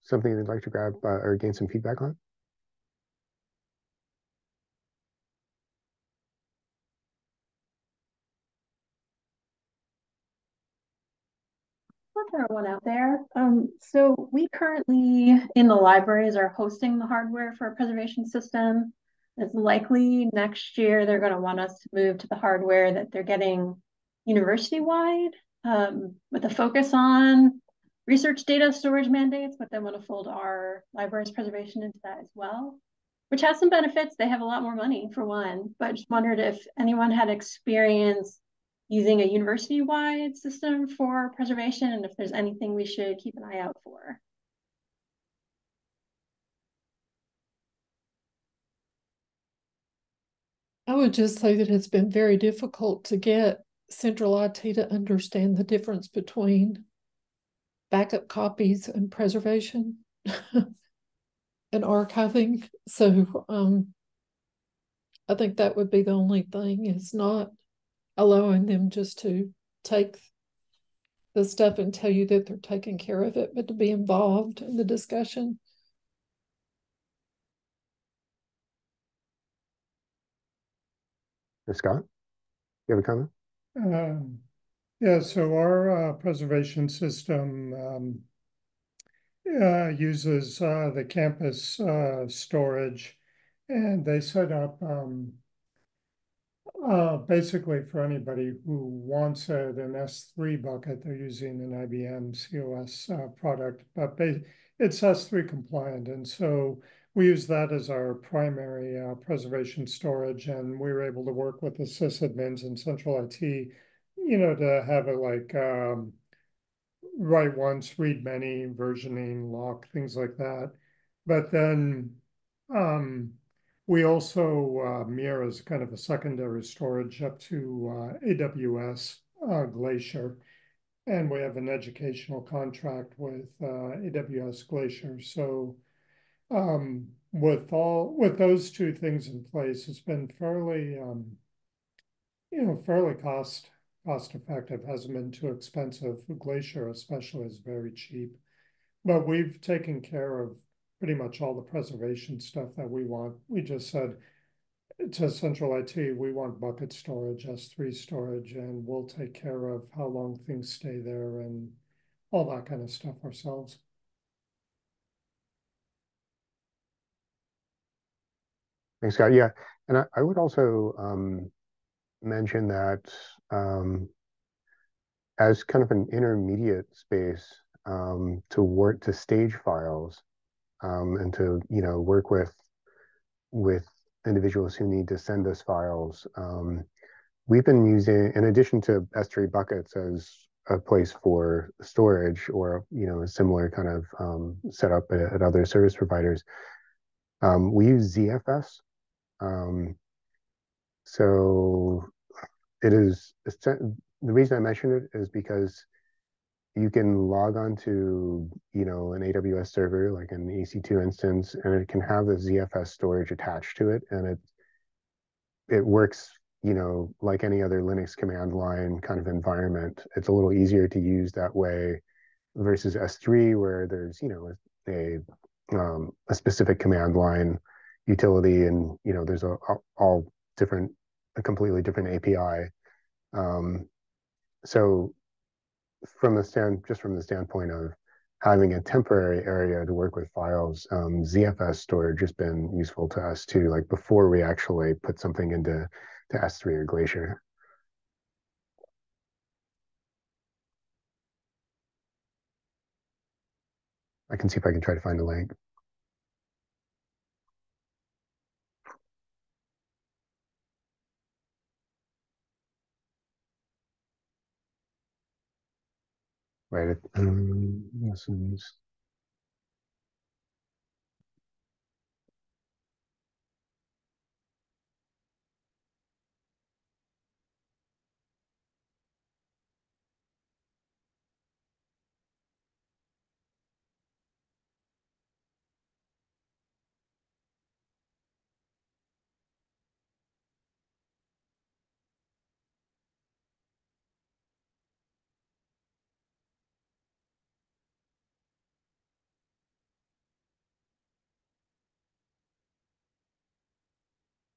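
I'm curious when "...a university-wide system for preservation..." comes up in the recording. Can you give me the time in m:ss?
0:39.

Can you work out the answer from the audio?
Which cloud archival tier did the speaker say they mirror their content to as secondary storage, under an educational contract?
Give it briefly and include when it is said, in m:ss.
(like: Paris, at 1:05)
AWS Glacier, at 2:08.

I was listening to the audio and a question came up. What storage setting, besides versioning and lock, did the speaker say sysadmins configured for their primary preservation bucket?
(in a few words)
write once, read many.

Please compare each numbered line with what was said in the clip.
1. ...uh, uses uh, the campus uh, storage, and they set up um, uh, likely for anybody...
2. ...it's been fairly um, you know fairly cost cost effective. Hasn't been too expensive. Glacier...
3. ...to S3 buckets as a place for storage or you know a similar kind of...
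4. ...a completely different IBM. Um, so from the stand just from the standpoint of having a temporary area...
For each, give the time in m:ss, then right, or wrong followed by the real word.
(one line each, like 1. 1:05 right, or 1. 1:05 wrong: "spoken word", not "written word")
1. 1:29 wrong: "basically", not "likely"
2. 2:19 right
3. 3:08 right
4. 3:51 wrong: "API", not "IBM".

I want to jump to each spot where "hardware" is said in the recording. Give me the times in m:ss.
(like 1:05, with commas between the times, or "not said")
0:17, 0:22.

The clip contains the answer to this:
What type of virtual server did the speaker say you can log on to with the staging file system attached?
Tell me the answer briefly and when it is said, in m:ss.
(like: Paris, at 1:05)
EC2 instance, at 3:30.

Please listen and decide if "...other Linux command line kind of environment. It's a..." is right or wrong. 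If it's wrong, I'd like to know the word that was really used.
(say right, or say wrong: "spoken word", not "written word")
right.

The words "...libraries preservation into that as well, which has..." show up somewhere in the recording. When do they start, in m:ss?
0:30.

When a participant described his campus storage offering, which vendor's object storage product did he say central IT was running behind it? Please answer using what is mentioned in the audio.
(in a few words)
IBM COS.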